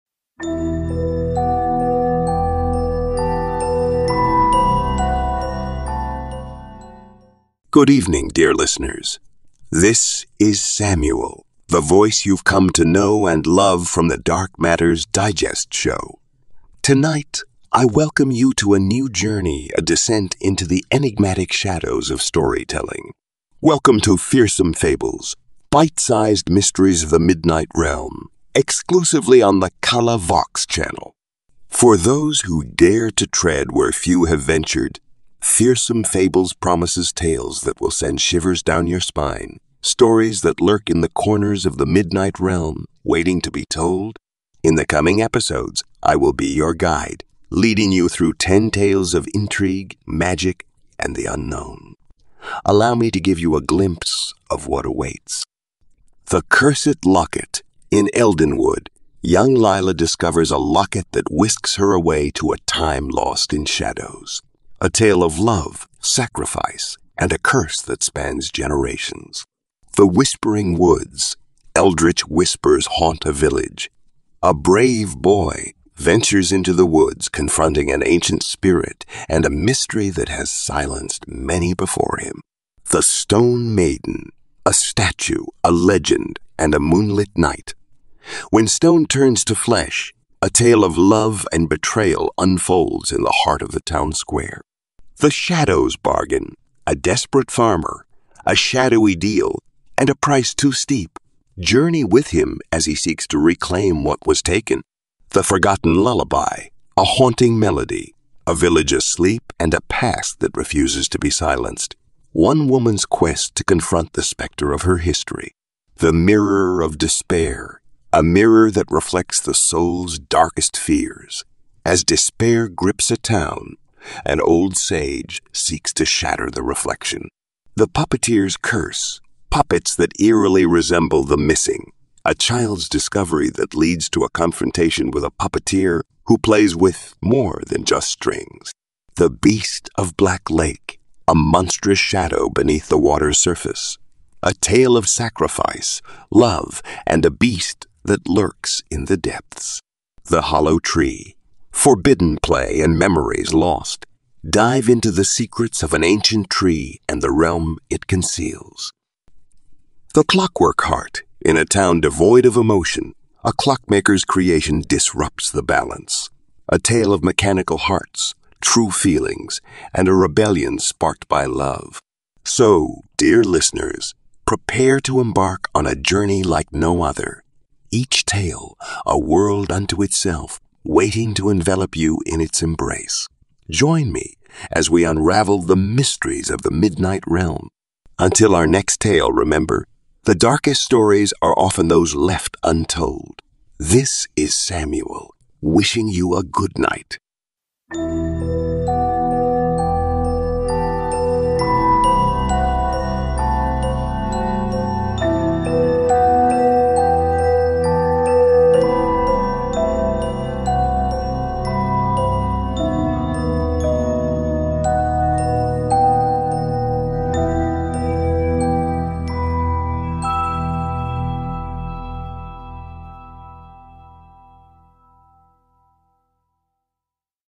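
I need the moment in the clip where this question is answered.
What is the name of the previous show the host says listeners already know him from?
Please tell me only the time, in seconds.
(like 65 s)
14 s.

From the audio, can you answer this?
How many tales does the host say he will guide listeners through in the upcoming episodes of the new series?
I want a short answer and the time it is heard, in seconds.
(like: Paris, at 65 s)
10, at 48 s.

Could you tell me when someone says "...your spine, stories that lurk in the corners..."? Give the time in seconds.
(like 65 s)
38 s.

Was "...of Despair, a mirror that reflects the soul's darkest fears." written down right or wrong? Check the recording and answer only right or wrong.
right.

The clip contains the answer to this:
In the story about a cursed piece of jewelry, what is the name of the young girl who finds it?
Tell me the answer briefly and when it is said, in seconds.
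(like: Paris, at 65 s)
Lila, at 59 s.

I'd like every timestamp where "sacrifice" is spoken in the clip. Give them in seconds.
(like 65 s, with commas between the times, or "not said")
65 s, 145 s.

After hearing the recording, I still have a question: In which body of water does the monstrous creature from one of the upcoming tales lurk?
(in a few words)
Black Lake.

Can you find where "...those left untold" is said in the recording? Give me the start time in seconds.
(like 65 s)
191 s.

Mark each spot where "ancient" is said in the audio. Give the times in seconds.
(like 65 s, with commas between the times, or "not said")
78 s, 156 s.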